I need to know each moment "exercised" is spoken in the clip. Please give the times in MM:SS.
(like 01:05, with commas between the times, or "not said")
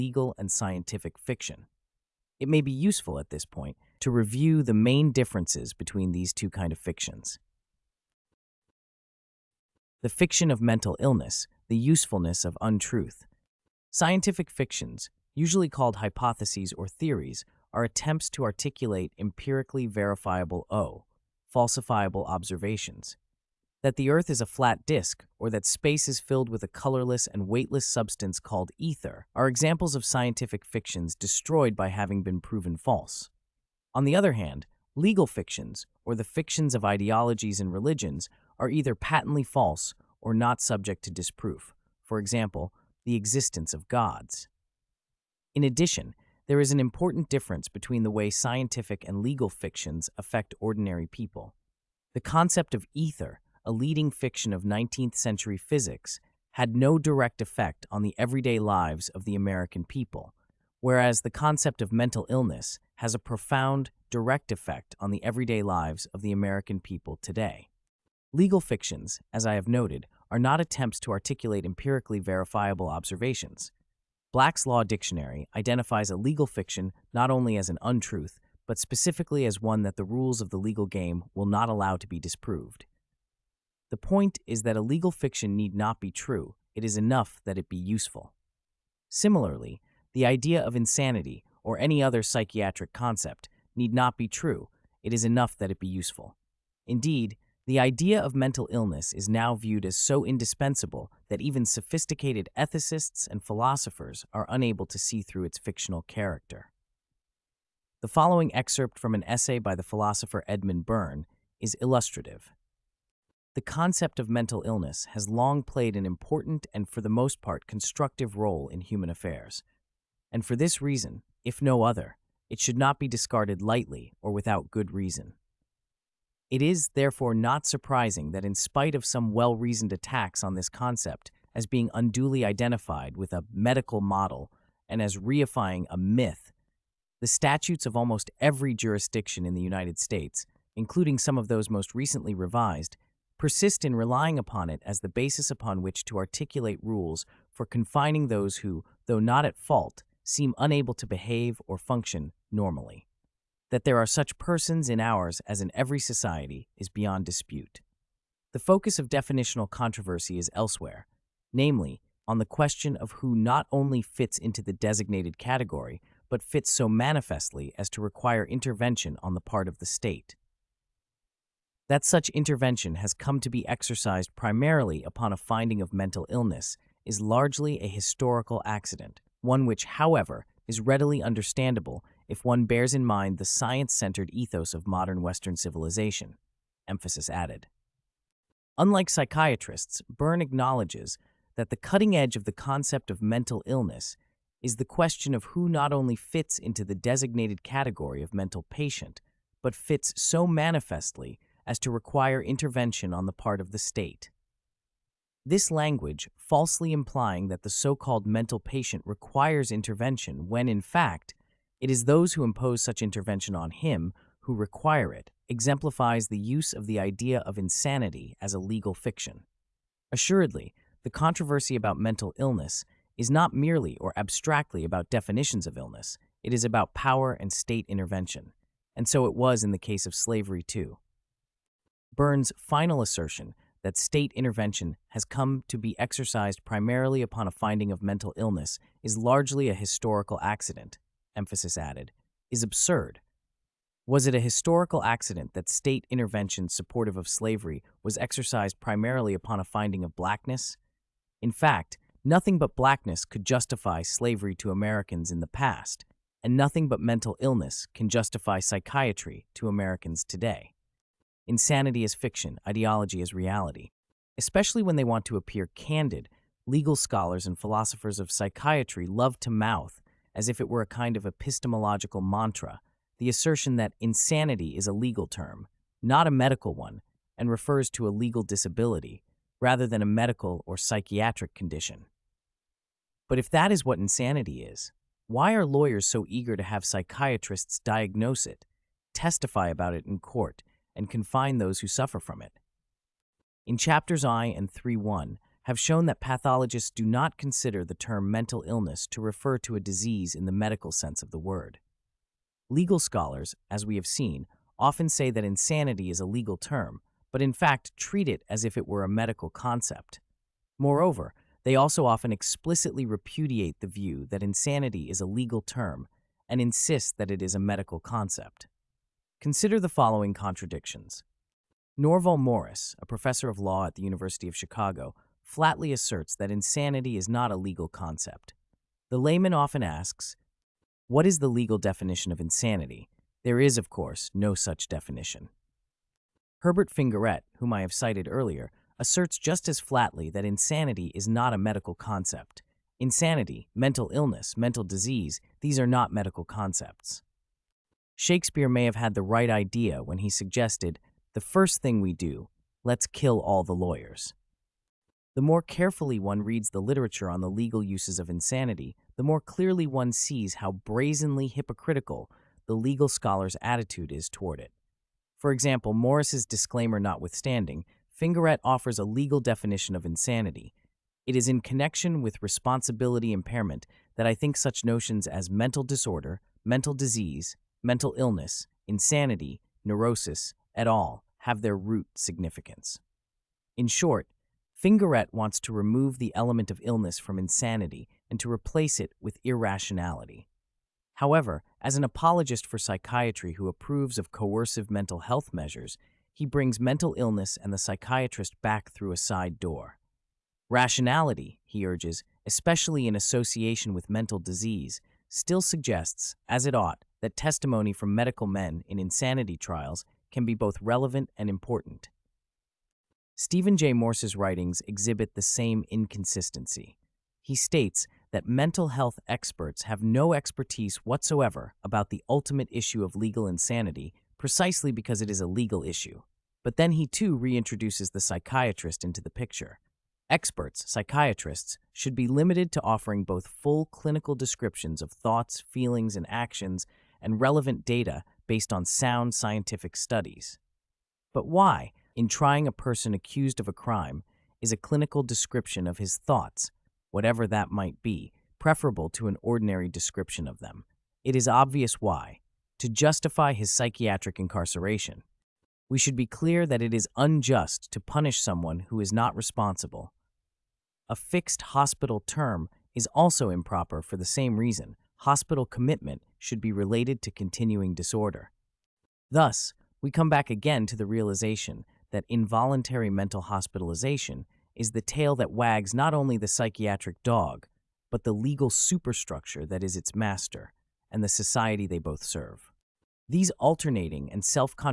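02:53, 03:55, 04:08.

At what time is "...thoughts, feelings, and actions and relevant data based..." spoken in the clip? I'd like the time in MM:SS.
07:15.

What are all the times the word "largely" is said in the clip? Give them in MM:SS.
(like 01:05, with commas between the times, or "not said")
02:57, 03:59.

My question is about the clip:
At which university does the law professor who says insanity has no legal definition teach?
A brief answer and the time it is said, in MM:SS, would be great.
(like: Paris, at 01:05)
University of Chicago, at 05:24.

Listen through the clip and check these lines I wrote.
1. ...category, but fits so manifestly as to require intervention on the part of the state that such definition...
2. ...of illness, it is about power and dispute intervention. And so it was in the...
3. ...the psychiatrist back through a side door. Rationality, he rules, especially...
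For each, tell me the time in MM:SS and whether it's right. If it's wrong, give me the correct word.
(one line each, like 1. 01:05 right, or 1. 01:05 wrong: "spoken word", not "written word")
1. 02:45 wrong: "intervention", not "definition"
2. 03:45 wrong: "state", not "dispute"
3. 06:37 wrong: "urges", not "rules".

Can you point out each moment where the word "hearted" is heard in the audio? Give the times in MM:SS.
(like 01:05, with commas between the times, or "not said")
not said.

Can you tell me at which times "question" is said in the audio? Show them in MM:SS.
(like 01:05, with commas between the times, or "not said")
02:42, 03:14.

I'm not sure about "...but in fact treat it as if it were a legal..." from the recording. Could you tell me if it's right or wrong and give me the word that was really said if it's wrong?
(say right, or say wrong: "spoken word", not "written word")
wrong: "medical", not "legal".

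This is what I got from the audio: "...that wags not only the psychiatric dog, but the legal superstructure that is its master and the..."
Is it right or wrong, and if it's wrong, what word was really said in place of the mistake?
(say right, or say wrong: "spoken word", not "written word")
right.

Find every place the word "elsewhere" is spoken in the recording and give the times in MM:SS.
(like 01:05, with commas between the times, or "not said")
02:40.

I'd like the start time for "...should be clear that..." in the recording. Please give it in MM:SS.
07:35.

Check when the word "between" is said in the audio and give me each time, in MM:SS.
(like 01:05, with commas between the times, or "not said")
00:05, 00:47.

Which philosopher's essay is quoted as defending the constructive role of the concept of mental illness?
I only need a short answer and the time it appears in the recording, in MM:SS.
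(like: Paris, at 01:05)
Edmund Byrne, at 01:50.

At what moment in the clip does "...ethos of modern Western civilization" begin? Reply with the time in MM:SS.
03:04.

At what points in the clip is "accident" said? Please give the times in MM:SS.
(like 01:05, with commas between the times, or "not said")
02:58, 04:00, 04:05.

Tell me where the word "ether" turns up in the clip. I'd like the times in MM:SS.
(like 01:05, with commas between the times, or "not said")
00:28, 00:52.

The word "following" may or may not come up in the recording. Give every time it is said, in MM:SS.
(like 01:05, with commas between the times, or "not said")
01:48, 05:19.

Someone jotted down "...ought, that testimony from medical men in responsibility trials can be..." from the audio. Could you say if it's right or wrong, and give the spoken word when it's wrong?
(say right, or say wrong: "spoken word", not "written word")
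wrong: "insanity", not "responsibility".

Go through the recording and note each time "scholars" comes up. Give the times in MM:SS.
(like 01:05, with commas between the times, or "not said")
04:26, 05:02, 06:03.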